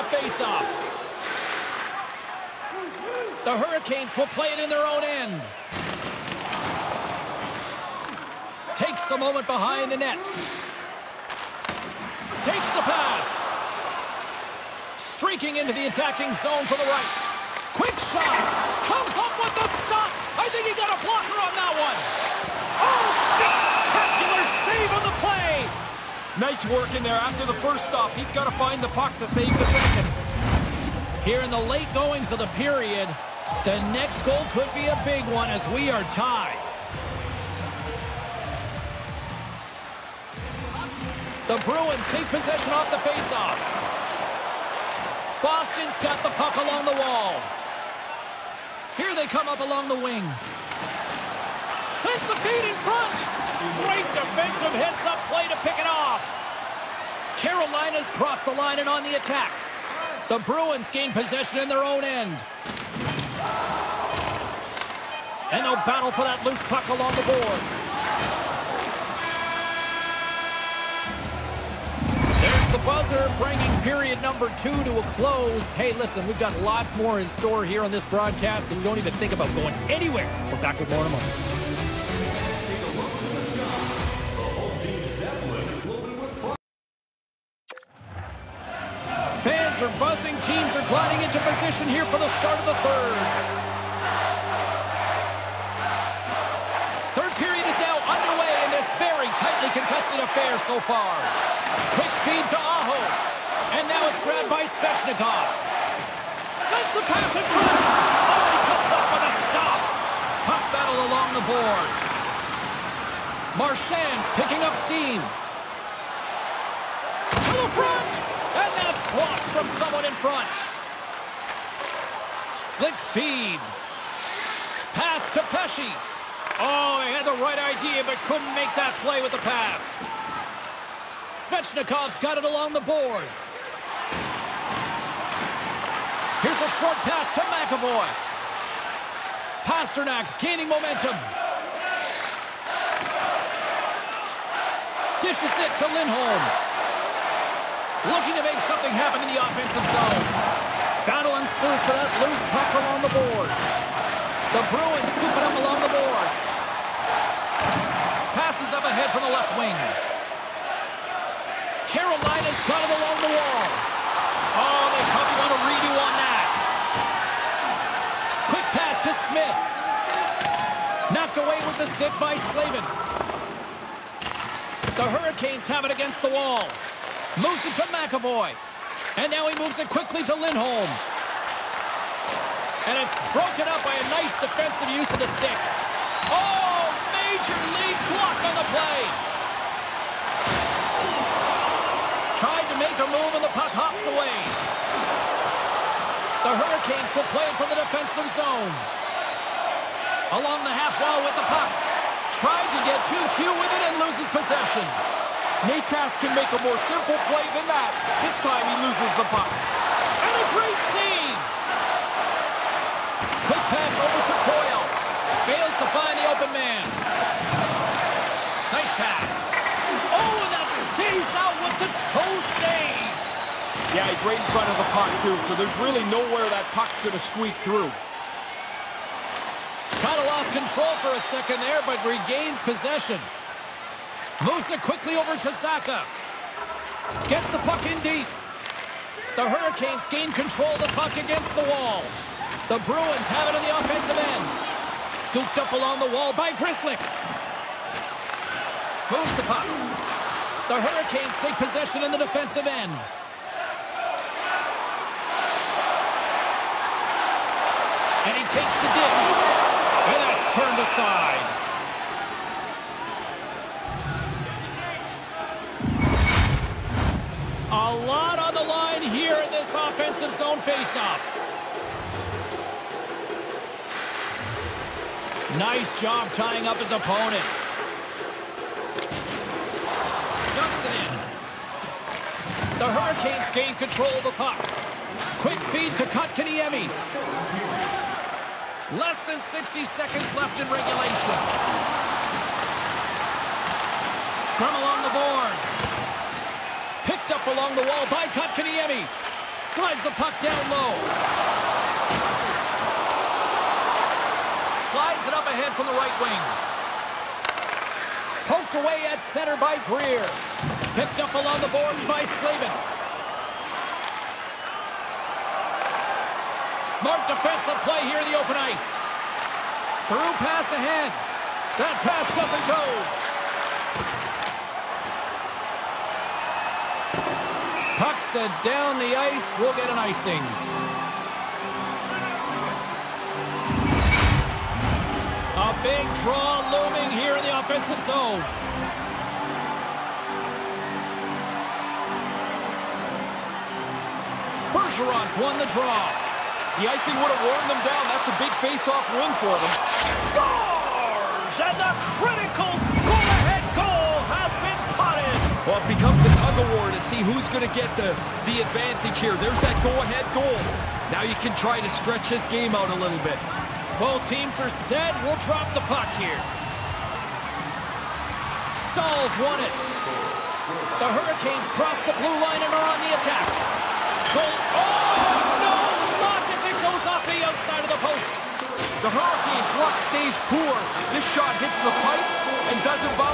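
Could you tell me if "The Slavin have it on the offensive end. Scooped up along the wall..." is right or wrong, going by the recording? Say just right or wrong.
wrong.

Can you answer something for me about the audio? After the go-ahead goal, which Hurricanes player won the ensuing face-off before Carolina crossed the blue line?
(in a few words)
Staal.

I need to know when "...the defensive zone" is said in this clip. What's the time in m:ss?
3:17.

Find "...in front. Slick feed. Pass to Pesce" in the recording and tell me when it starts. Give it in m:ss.
2:00.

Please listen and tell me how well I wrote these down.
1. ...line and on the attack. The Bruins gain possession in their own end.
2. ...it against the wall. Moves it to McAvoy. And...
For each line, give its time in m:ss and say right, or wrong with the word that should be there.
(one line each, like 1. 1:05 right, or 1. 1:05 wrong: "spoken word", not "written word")
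1. 0:58 right
2. 2:55 right.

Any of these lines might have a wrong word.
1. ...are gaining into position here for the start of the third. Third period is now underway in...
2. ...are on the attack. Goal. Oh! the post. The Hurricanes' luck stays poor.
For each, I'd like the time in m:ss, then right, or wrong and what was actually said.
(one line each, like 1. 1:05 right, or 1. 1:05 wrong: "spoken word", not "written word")
1. 1:30 wrong: "gliding", not "gaining"
2. 6:12 right.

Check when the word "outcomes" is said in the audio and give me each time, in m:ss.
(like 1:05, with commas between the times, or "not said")
not said.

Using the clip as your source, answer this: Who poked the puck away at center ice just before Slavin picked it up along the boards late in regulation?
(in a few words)
Greer.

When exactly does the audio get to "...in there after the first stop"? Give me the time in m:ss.
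0:26.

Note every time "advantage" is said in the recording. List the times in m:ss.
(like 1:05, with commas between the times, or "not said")
5:58.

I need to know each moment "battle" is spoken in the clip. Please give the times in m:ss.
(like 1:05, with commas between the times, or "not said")
1:05, 1:50, 2:31.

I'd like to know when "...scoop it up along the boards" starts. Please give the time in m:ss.
2:35.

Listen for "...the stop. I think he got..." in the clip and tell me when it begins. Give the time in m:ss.
0:19.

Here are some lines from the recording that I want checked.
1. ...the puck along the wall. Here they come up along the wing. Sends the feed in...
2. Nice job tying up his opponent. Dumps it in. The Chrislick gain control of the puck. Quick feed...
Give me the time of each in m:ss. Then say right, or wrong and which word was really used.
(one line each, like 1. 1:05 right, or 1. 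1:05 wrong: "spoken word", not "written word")
1. 0:46 right
2. 4:35 wrong: "Hurricanes", not "Chrislick".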